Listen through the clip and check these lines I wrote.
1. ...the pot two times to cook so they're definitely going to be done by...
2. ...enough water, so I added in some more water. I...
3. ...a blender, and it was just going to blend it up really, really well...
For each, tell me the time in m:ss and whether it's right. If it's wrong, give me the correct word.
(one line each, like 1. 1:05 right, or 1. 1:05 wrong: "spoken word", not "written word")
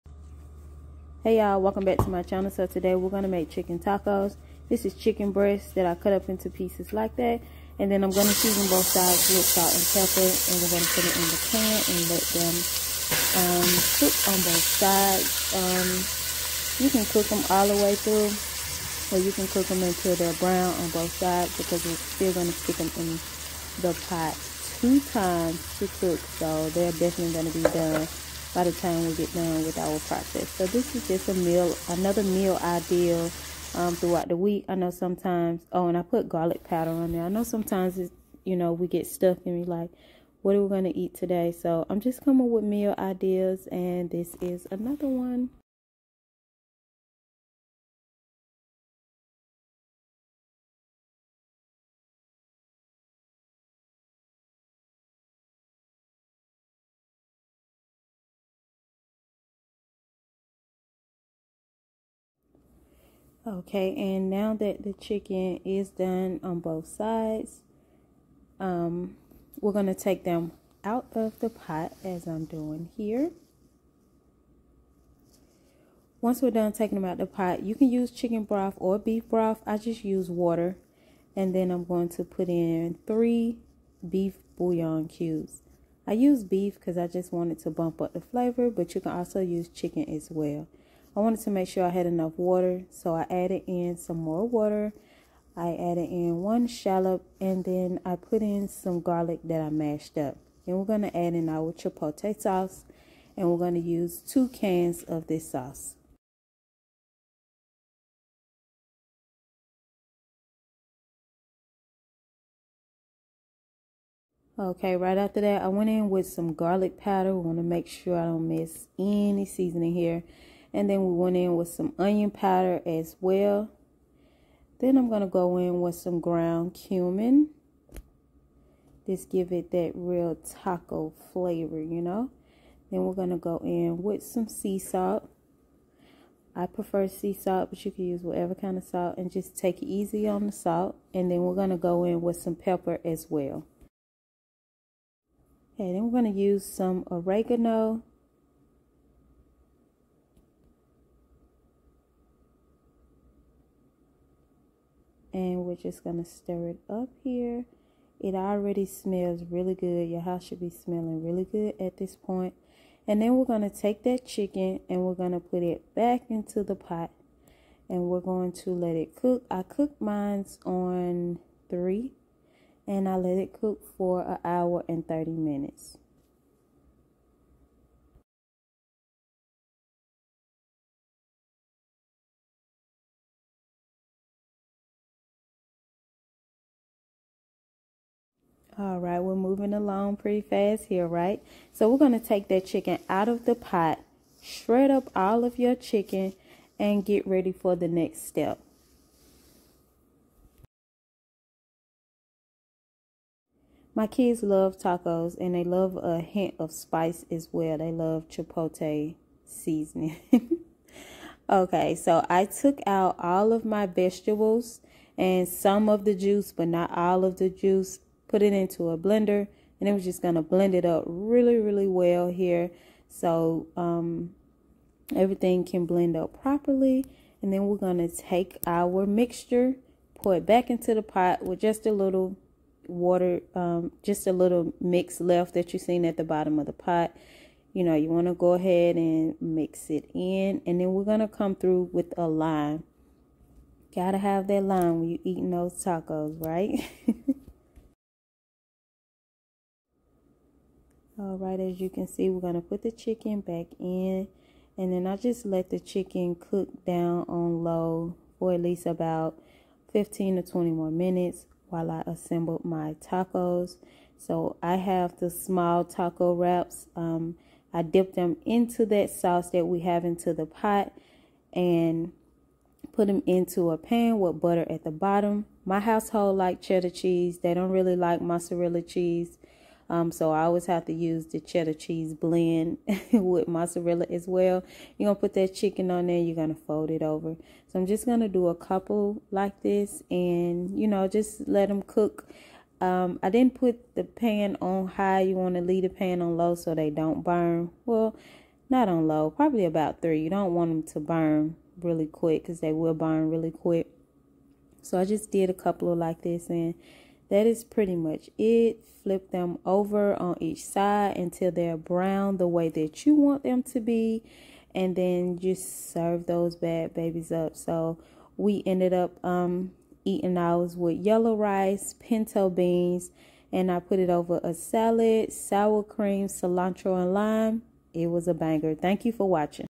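1. 0:23 right
2. 1:32 right
3. 3:38 right.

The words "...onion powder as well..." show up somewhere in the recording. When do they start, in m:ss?
2:01.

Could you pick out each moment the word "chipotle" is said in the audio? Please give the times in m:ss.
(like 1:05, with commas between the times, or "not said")
1:41, 3:28.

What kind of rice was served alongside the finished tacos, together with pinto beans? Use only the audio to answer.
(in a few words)
yellow rice.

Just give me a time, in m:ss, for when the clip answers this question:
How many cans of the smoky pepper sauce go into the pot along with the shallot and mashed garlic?
1:44.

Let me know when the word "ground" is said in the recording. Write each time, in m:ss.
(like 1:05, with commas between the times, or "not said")
2:06.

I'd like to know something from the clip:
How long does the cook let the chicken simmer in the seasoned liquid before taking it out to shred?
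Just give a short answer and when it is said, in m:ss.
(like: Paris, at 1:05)
1 hour 30 minutes, at 2:54.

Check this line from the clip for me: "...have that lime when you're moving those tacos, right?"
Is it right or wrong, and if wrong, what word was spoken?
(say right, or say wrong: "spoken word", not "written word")
wrong: "eating", not "moving".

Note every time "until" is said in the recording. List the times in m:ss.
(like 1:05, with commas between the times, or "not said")
0:19, 5:11.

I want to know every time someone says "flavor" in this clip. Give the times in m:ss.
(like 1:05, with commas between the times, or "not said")
1:28, 2:11.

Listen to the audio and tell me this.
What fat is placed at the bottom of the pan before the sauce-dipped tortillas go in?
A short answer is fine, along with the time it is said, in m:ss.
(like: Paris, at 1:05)
butter, at 4:34.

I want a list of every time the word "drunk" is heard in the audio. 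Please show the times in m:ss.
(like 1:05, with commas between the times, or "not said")
not said.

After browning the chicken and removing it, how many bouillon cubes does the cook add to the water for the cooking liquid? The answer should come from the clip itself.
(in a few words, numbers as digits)
3.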